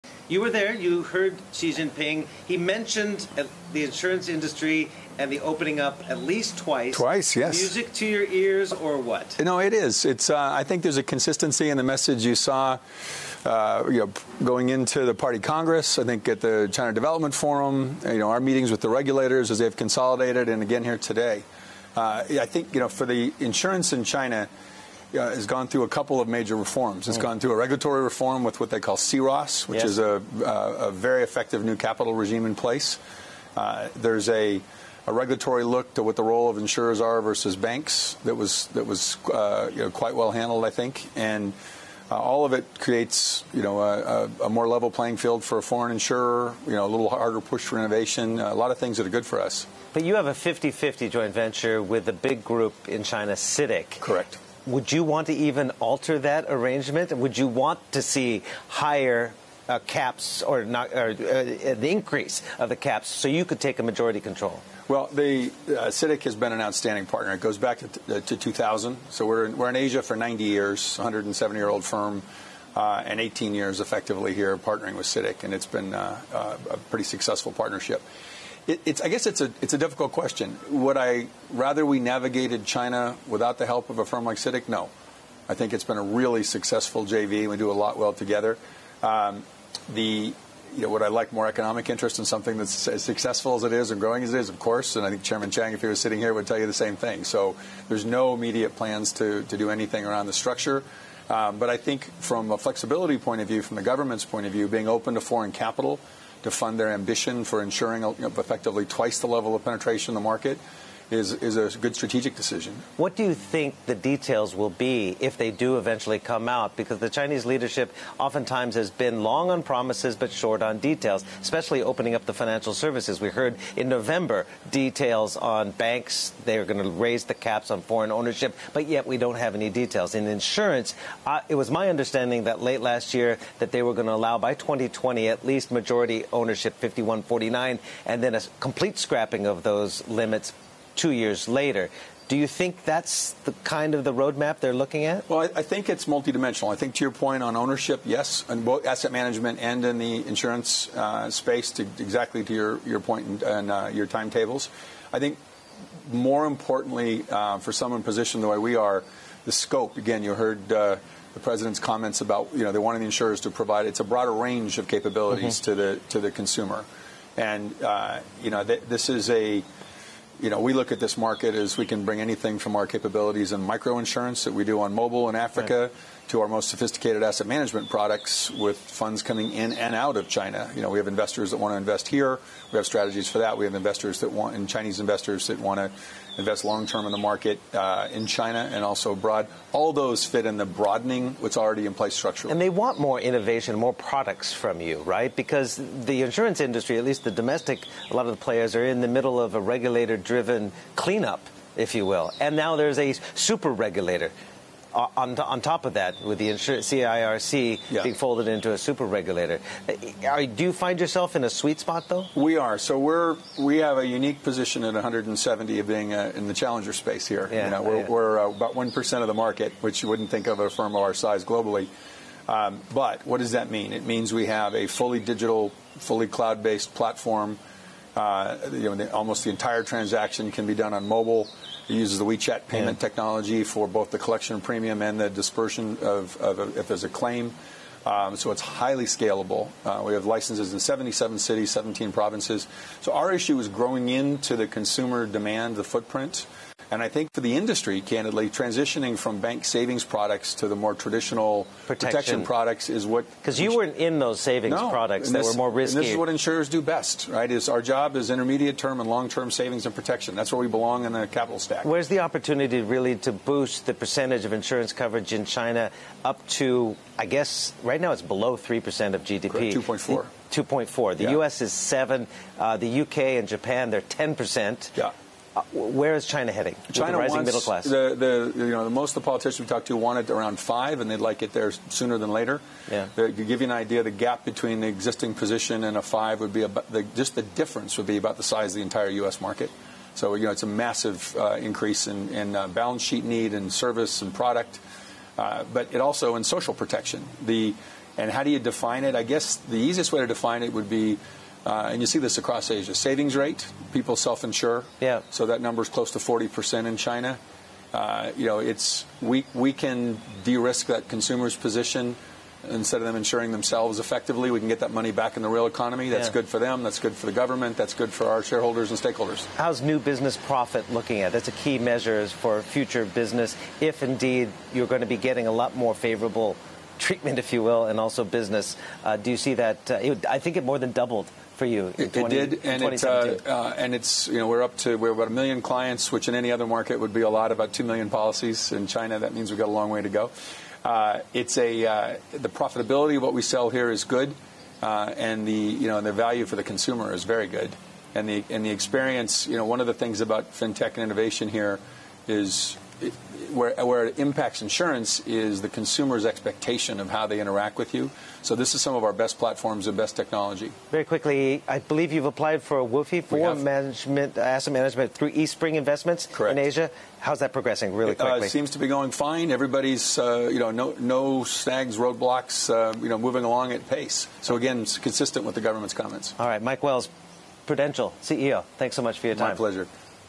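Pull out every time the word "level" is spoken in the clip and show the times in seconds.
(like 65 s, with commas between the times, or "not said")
44 s, 109 s.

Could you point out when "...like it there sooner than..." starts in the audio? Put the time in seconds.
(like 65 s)
281 s.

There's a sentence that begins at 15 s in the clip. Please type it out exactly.
I think at the China Development Forum, you know, our meetings with the regulators as they've consolidated, and again here today.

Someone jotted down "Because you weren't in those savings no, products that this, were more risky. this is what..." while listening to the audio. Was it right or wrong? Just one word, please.
right.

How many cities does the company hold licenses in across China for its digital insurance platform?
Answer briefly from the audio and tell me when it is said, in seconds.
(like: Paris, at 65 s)
77, at 240 s.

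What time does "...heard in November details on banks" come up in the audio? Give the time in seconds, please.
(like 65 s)
123 s.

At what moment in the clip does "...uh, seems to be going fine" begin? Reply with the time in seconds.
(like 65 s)
368 s.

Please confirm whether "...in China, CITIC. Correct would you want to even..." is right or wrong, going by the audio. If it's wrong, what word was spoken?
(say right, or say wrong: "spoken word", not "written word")
right.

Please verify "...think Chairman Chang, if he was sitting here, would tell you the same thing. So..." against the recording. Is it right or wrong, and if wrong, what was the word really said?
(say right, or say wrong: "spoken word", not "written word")
right.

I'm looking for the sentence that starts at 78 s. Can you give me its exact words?
It, it's, I guess it's a, it's a difficult question.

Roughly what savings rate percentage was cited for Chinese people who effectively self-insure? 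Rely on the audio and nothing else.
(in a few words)
40%.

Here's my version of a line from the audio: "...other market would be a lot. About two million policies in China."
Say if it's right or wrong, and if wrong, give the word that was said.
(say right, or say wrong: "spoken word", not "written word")
right.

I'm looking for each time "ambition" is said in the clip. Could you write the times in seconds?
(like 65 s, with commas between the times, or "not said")
106 s.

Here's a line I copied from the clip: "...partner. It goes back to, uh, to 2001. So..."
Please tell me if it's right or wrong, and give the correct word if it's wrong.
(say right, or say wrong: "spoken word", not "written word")
wrong: "2000", not "2001".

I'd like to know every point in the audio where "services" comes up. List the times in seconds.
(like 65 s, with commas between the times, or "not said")
122 s, 293 s.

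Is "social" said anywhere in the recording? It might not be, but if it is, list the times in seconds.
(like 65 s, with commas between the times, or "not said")
296 s.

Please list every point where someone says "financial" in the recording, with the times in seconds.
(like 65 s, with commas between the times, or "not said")
122 s.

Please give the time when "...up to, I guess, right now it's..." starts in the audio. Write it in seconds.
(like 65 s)
266 s.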